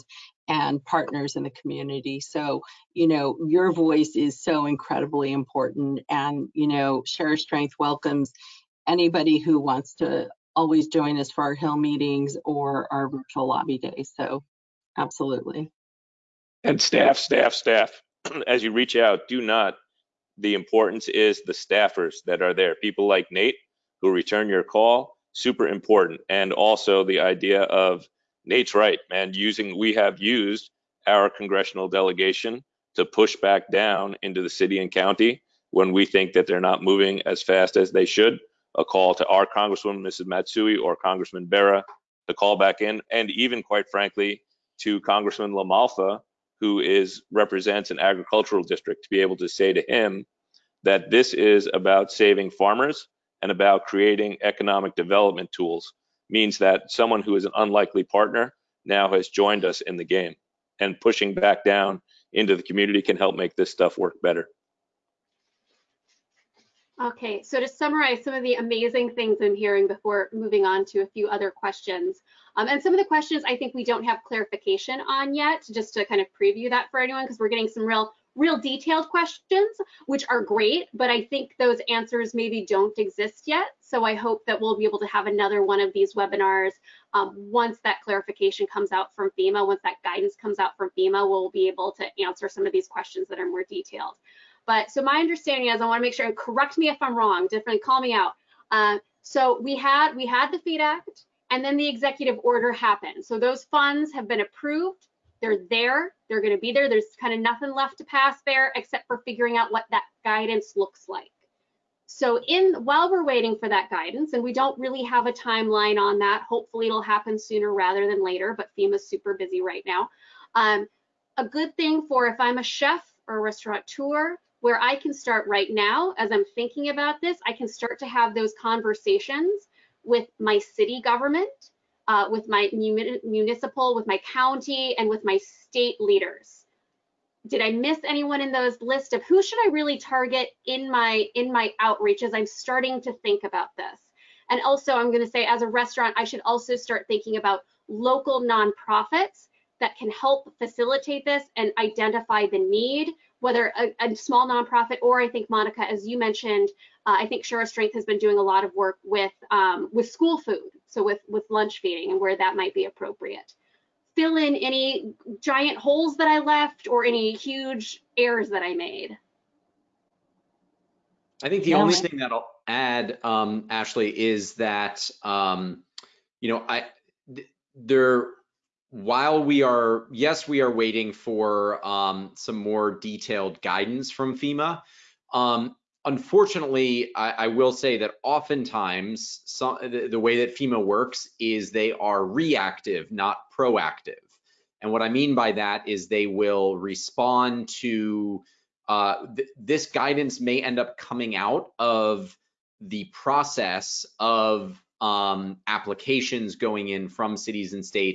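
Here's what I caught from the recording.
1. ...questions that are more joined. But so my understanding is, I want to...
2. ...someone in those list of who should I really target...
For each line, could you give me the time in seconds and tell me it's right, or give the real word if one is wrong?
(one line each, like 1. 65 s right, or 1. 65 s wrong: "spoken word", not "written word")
1. 92 s wrong: "detailed", not "joined"
2. 138 s wrong: "anyone", not "someone".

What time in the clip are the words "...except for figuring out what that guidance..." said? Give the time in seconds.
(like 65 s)
108 s.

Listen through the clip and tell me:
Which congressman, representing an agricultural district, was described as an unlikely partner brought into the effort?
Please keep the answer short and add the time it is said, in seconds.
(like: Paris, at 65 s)
LaMalfa, at 45 s.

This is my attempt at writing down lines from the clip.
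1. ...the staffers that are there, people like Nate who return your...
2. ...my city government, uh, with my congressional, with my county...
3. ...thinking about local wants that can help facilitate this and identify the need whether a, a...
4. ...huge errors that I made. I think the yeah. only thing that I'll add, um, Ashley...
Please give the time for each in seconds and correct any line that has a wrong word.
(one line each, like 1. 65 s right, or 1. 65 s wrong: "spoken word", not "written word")
1. 21 s right
2. 130 s wrong: "municipal", not "congressional"
3. 147 s wrong: "nonprofits", not "wants"
4. 167 s right.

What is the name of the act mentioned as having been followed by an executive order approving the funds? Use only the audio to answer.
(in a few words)
Feed Act.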